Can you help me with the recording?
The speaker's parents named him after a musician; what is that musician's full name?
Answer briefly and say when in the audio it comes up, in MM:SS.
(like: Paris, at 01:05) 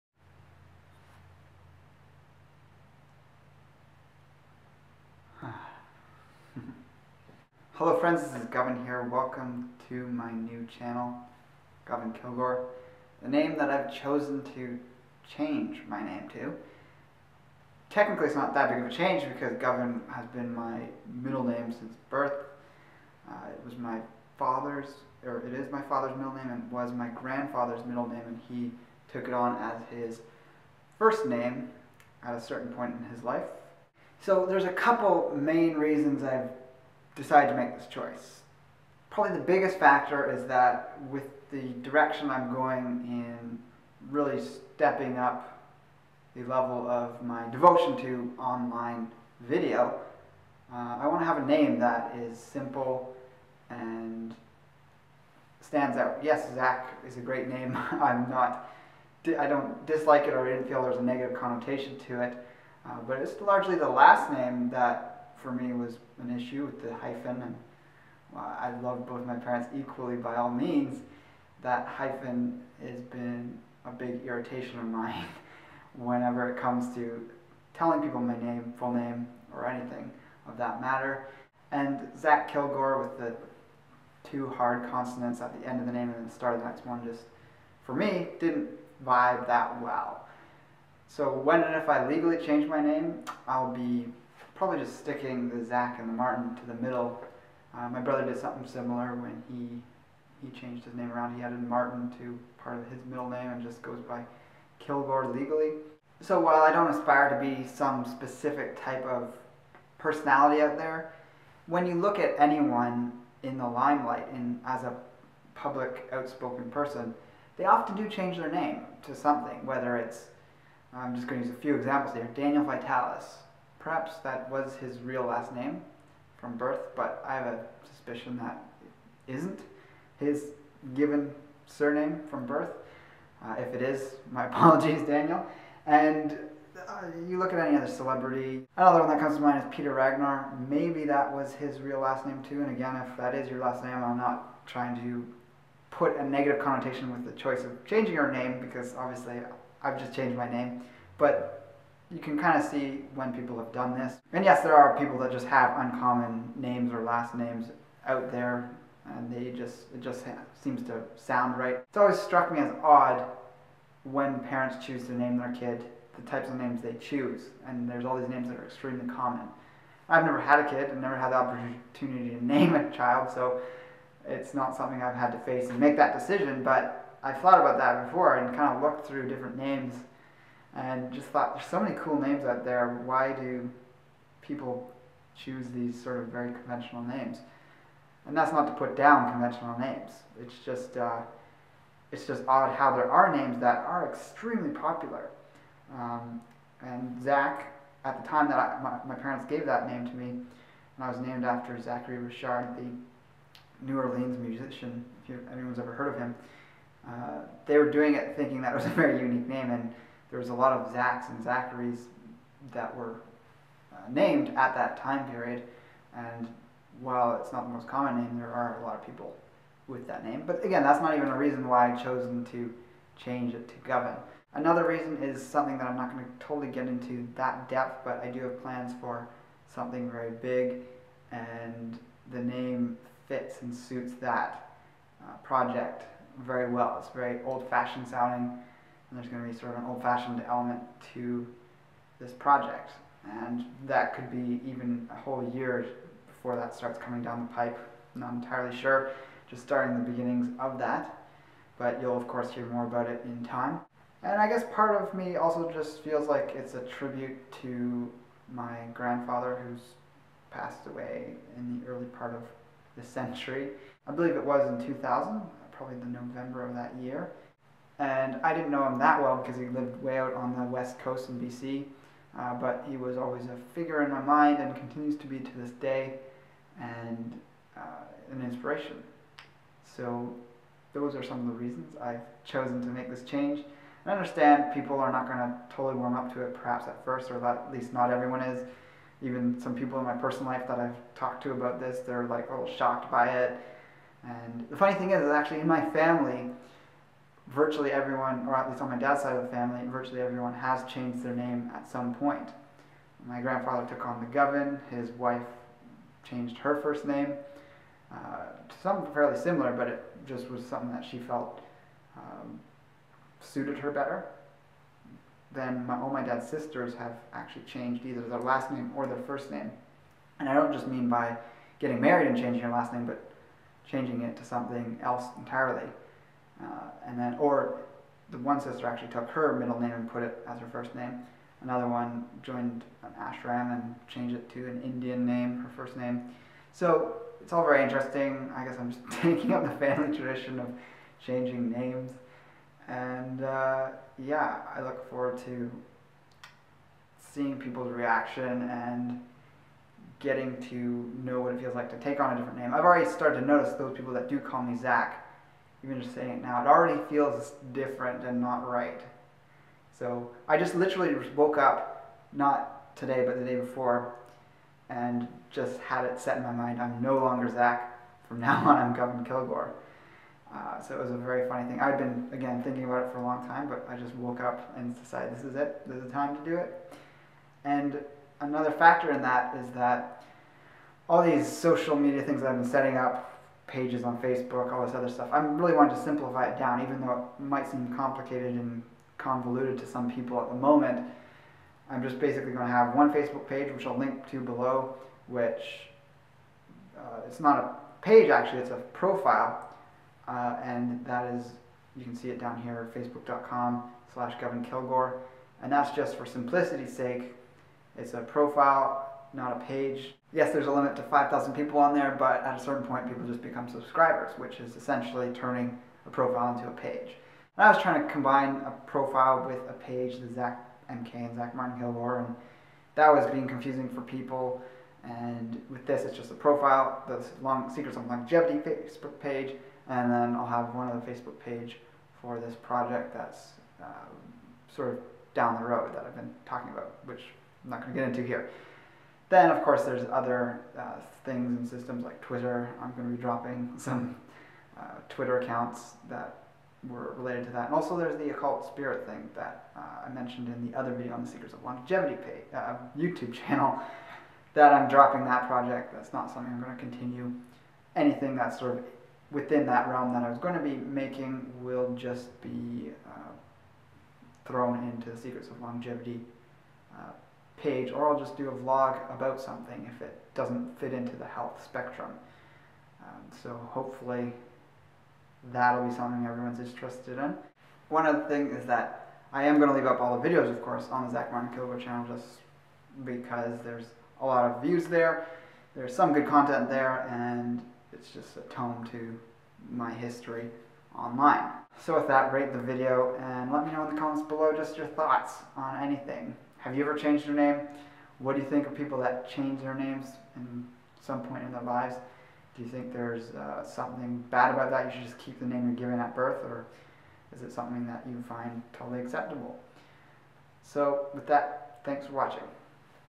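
Zachary Richard, at 03:21.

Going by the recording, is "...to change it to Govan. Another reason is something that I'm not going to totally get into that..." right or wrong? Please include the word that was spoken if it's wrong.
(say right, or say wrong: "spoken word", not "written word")
right.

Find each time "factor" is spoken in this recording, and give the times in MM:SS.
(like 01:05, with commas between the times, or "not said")
00:39, 06:18.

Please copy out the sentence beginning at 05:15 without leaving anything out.
Then my, all my dad's sisters have actually changed either their last name or their first name.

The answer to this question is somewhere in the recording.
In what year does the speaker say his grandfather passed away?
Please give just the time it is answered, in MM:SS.
04:24.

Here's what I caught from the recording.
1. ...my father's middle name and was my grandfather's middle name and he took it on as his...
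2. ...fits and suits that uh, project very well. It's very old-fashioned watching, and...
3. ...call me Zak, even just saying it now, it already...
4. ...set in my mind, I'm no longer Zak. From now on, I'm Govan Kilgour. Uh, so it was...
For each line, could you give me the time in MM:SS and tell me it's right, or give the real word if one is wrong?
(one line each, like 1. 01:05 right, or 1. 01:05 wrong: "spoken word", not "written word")
1. 00:25 right
2. 03:53 wrong: "sounding", not "watching"
3. 05:54 right
4. 06:06 right.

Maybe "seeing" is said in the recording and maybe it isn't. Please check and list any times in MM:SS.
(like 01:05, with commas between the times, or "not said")
05:47.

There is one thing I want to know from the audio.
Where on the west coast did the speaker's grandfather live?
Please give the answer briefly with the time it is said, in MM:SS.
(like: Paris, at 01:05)
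BC, at 04:31.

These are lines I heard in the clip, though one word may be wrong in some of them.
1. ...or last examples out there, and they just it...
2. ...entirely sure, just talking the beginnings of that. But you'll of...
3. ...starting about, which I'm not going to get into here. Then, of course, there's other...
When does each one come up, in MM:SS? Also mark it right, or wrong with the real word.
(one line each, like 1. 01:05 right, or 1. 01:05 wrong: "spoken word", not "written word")
1. 02:36 wrong: "names", not "examples"
2. 04:08 wrong: "starting", not "talking"
3. 07:16 wrong: "talking", not "starting".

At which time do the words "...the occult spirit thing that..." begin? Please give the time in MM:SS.
07:28.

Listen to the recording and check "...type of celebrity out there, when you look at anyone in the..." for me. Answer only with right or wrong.
wrong.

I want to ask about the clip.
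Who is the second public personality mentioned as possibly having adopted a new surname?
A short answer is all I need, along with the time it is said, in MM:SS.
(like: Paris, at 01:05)
Peter Ragnar, at 02:19.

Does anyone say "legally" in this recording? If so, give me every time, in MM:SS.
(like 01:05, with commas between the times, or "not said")
01:32, 01:45.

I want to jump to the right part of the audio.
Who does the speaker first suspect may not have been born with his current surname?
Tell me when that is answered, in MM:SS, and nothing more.
02:02.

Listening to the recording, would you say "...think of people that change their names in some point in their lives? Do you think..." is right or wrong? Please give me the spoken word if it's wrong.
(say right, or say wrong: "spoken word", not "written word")
right.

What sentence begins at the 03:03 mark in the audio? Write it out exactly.
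Why do people choose these sort of very conventional names?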